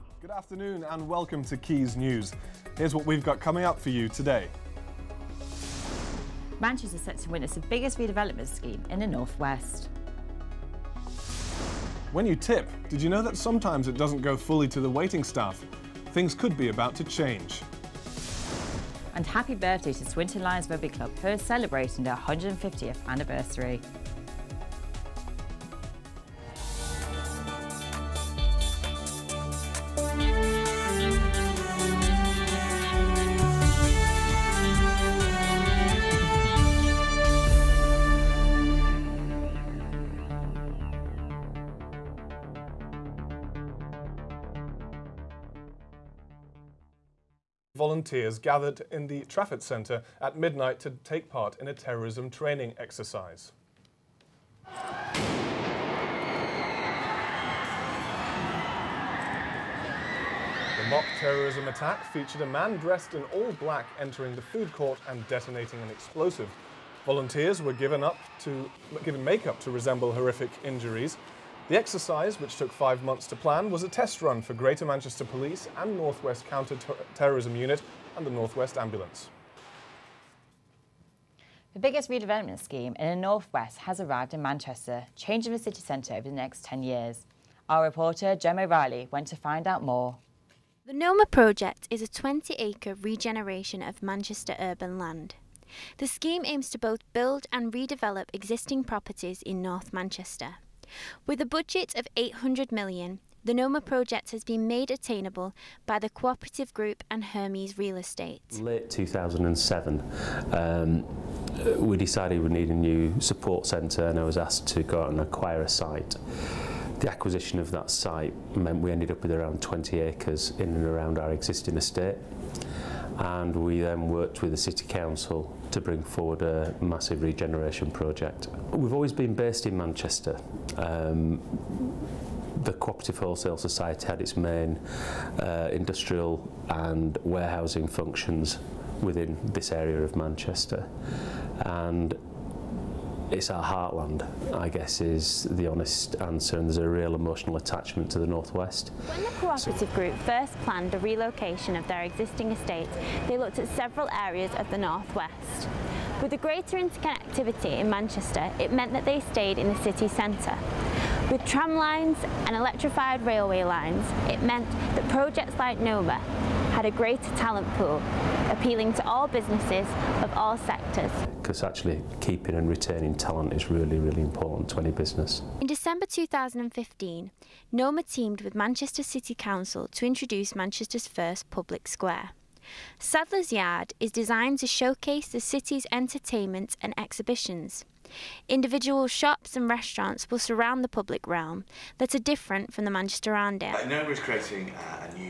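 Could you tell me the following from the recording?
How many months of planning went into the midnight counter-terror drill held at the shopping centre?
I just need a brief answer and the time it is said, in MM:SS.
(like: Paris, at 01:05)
5, at 01:12.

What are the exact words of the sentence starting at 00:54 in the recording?
The mock terrorism attack featured a man dressed in all black entering the food court and detonating an explosive.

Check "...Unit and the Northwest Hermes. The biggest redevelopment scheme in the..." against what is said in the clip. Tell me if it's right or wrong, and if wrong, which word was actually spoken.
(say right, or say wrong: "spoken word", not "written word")
wrong: "Ambulance", not "Hermes".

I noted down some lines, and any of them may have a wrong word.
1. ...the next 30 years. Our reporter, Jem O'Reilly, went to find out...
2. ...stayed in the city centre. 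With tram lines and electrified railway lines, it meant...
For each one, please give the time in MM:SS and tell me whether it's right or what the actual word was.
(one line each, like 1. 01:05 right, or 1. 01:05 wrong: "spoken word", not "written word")
1. 01:26 wrong: "10", not "30"
2. 02:39 right.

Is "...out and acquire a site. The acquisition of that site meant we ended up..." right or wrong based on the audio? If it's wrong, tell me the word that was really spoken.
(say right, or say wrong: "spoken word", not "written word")
right.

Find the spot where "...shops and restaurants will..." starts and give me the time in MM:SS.
03:09.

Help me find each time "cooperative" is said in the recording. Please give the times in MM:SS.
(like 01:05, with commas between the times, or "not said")
01:46, 02:12, 02:29.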